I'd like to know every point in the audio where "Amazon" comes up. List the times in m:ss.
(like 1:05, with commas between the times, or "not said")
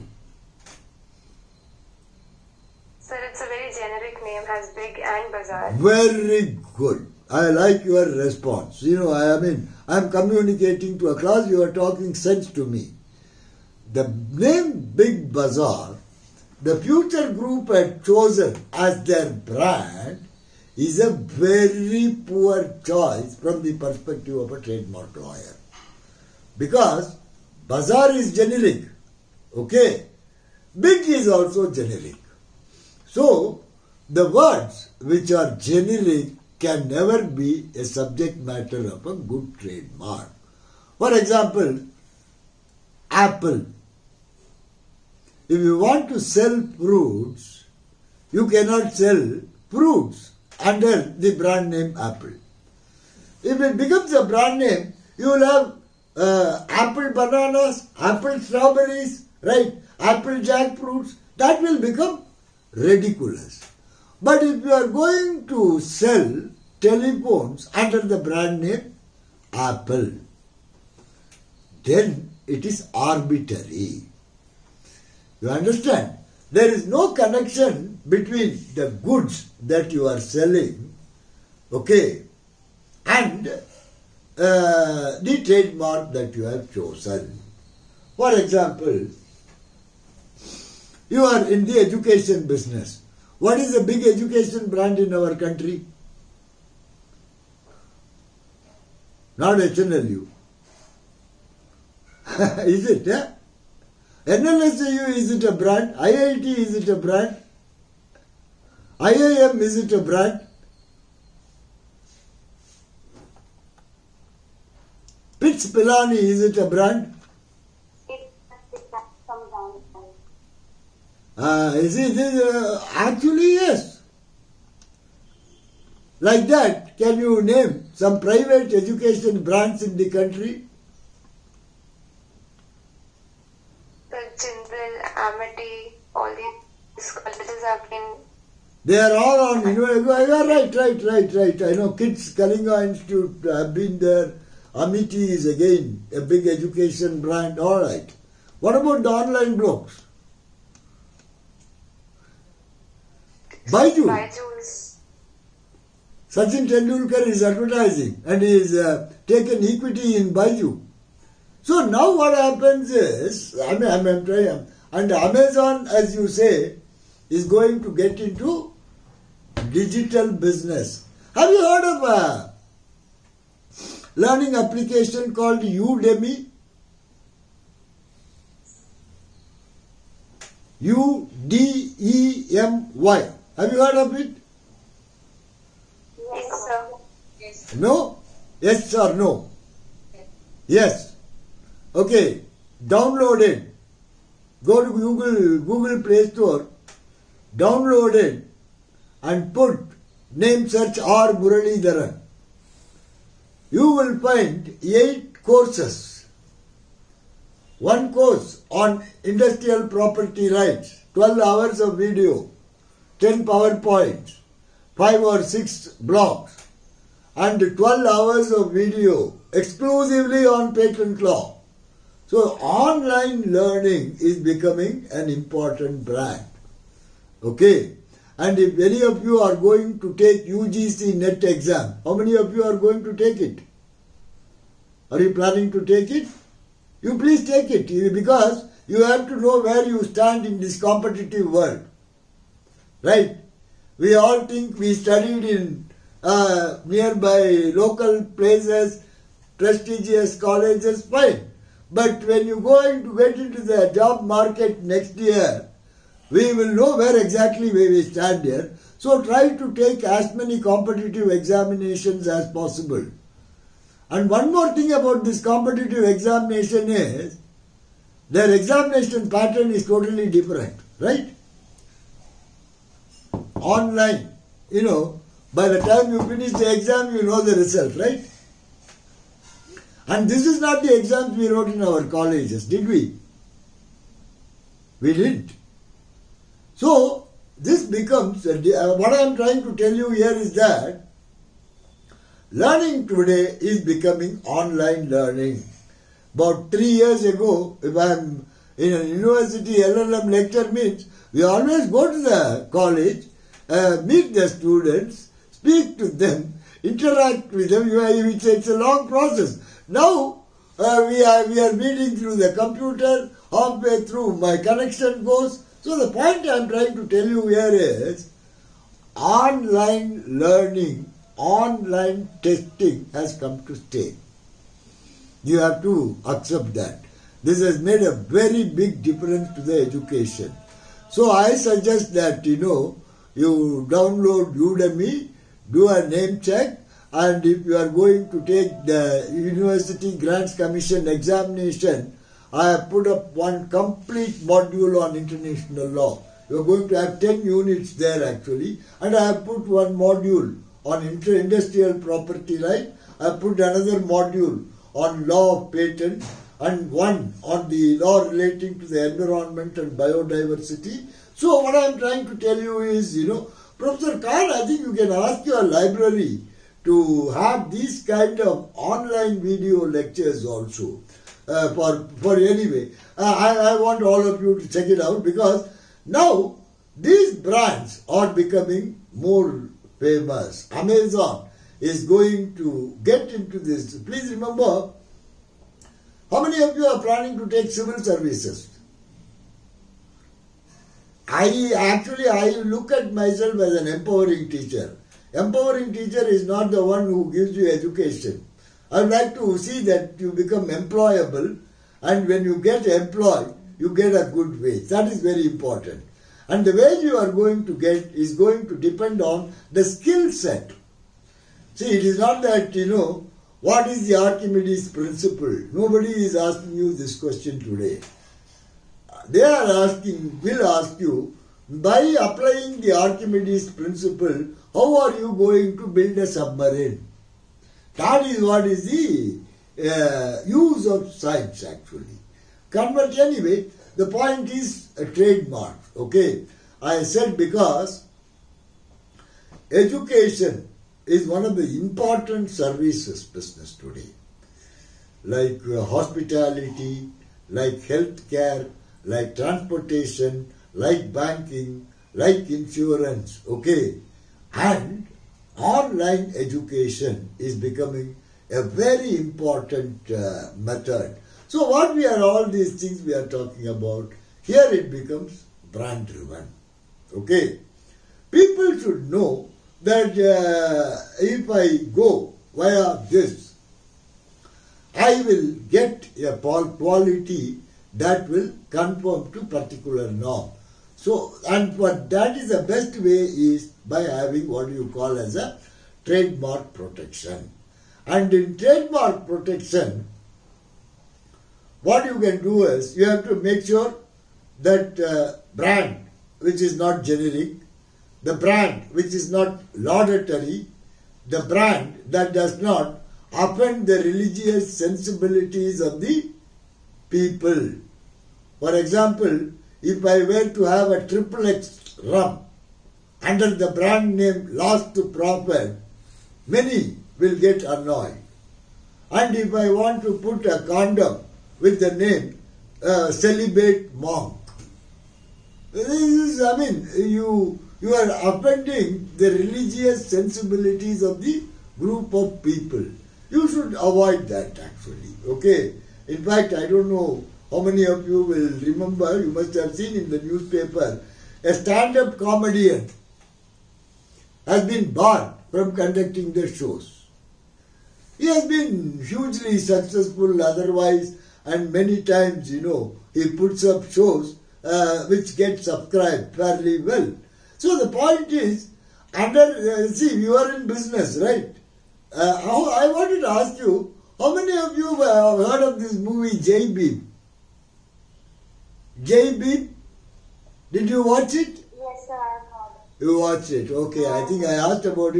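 2:45, 6:20.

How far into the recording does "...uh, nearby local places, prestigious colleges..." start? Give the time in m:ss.
4:06.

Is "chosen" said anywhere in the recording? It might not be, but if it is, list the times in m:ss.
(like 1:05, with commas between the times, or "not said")
0:18, 1:26.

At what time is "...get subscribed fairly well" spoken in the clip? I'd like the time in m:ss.
9:15.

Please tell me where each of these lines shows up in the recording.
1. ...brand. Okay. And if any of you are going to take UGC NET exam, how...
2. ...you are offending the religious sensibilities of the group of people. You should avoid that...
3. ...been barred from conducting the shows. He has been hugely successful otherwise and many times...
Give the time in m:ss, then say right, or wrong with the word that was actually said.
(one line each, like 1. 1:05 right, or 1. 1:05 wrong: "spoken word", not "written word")
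1. 3:46 right
2. 8:47 right
3. 9:04 right.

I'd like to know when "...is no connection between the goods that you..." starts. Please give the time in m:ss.
1:16.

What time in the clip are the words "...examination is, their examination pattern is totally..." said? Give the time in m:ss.
4:26.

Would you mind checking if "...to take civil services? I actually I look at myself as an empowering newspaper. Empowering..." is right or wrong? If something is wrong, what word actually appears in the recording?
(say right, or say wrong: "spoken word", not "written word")
wrong: "teacher", not "newspaper".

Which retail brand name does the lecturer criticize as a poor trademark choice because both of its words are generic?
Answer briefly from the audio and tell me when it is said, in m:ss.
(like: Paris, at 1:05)
Big Bazaar, at 0:14.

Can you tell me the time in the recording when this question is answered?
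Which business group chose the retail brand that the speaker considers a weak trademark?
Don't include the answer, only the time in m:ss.
0:16.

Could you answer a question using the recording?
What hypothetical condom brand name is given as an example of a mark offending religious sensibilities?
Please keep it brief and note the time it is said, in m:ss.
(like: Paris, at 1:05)
Celibate Monk, at 8:43.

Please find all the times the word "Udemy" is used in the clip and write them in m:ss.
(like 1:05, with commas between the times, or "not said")
2:55, 5:34.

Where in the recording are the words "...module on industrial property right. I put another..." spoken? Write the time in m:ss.
5:49.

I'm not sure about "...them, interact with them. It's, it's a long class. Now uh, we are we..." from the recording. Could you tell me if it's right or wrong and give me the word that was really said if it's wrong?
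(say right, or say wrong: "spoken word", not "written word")
wrong: "process", not "class".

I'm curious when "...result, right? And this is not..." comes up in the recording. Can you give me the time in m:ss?
4:37.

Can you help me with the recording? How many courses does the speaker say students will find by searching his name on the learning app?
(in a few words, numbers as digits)
8.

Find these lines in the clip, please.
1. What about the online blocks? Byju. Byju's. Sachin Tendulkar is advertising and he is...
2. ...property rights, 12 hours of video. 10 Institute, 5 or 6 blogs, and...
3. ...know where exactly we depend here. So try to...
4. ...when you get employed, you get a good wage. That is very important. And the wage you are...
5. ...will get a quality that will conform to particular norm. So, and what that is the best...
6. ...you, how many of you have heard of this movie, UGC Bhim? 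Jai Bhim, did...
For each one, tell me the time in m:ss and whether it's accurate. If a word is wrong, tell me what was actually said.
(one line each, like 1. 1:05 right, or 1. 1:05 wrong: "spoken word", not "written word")
1. 2:28 right
2. 3:29 wrong: "PowerPoints", not "Institute"
3. 4:16 wrong: "stand", not "depend"
4. 6:42 right
5. 7:55 right
6. 9:23 wrong: "Jai", not "UGC".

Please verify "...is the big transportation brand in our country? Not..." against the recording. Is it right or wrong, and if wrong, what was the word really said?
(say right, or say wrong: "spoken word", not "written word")
wrong: "education", not "transportation".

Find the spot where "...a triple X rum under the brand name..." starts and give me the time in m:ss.
8:30.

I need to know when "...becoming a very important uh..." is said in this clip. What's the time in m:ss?
7:37.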